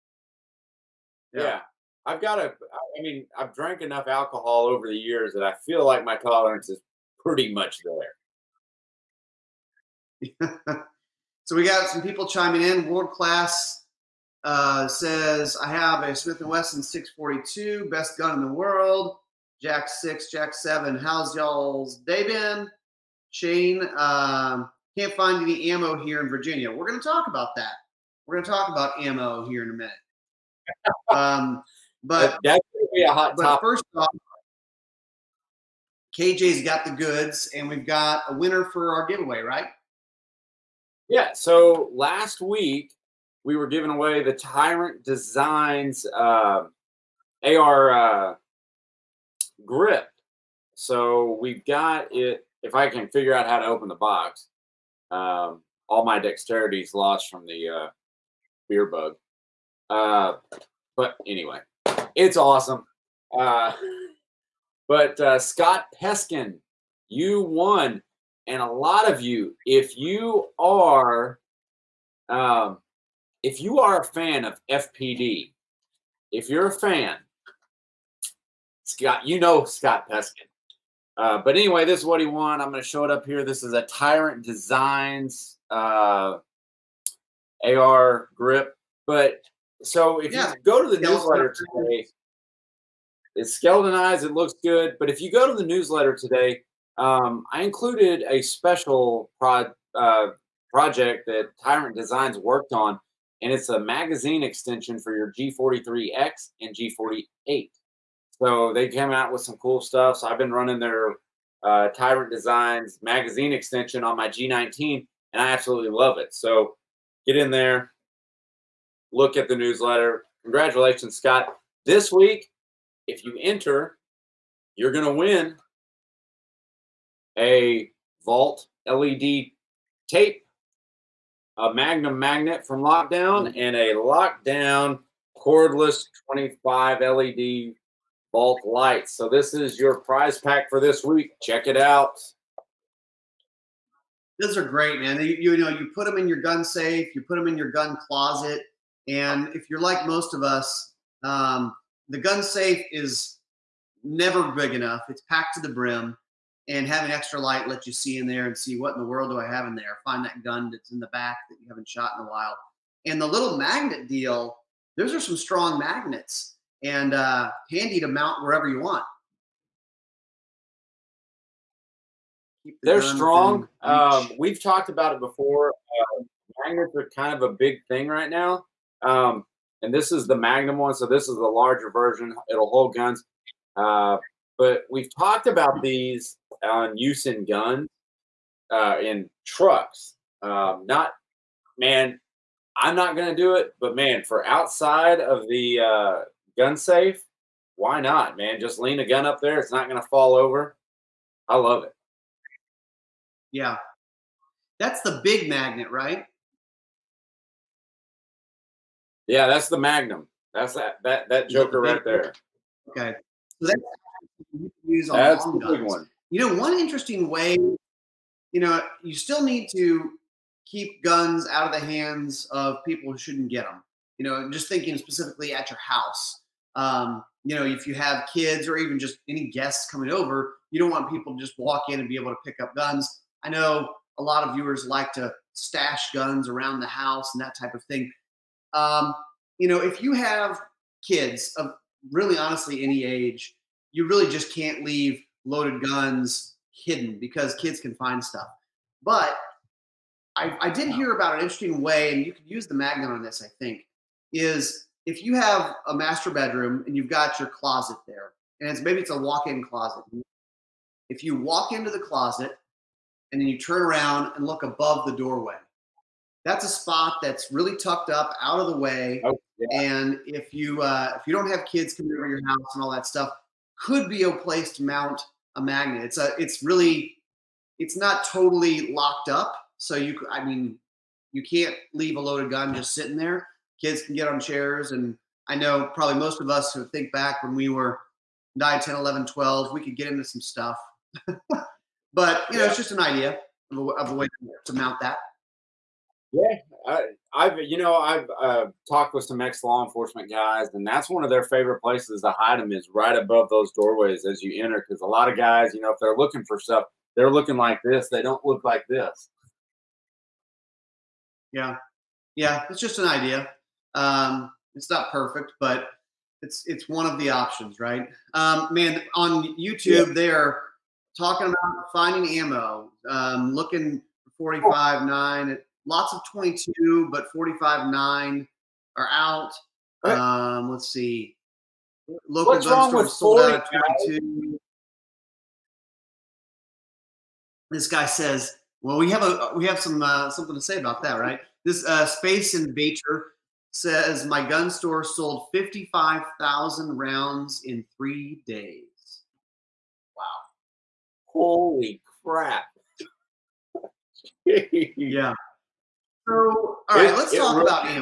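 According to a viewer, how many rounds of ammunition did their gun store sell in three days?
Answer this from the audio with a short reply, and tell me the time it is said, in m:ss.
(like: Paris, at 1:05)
55,000, at 5:45.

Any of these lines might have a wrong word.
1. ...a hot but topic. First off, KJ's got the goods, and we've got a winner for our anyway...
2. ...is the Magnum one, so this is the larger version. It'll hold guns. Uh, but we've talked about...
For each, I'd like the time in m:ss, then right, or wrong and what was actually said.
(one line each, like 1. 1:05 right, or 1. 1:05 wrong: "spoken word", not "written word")
1. 0:33 wrong: "giveaway", not "anyway"
2. 3:00 right.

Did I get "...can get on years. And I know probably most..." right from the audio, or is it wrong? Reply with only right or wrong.
wrong.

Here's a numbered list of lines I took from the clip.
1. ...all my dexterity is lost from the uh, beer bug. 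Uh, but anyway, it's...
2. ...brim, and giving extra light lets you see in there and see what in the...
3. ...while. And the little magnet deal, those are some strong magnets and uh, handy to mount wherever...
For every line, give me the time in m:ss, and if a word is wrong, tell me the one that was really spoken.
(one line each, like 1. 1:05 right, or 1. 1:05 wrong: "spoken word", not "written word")
1. 0:55 right
2. 2:35 wrong: "having", not "giving"
3. 2:42 right.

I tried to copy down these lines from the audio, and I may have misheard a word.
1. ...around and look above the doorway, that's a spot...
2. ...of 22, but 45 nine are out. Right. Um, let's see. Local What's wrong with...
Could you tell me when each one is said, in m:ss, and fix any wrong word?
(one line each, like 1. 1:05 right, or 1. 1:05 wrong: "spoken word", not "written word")
1. 4:23 right
2. 5:26 right.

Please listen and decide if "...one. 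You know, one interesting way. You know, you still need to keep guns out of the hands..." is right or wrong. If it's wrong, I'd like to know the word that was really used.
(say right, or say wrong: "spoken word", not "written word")
right.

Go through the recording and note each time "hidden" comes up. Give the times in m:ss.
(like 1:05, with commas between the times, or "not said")
4:06.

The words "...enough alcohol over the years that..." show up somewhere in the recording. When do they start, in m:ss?
0:03.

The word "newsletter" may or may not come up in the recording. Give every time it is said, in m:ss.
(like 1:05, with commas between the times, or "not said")
1:31, 1:35, 1:59.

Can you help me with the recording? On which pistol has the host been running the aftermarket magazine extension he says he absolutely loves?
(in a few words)
G19.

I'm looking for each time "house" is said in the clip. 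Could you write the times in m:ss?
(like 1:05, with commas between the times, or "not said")
3:45, 3:56, 4:32.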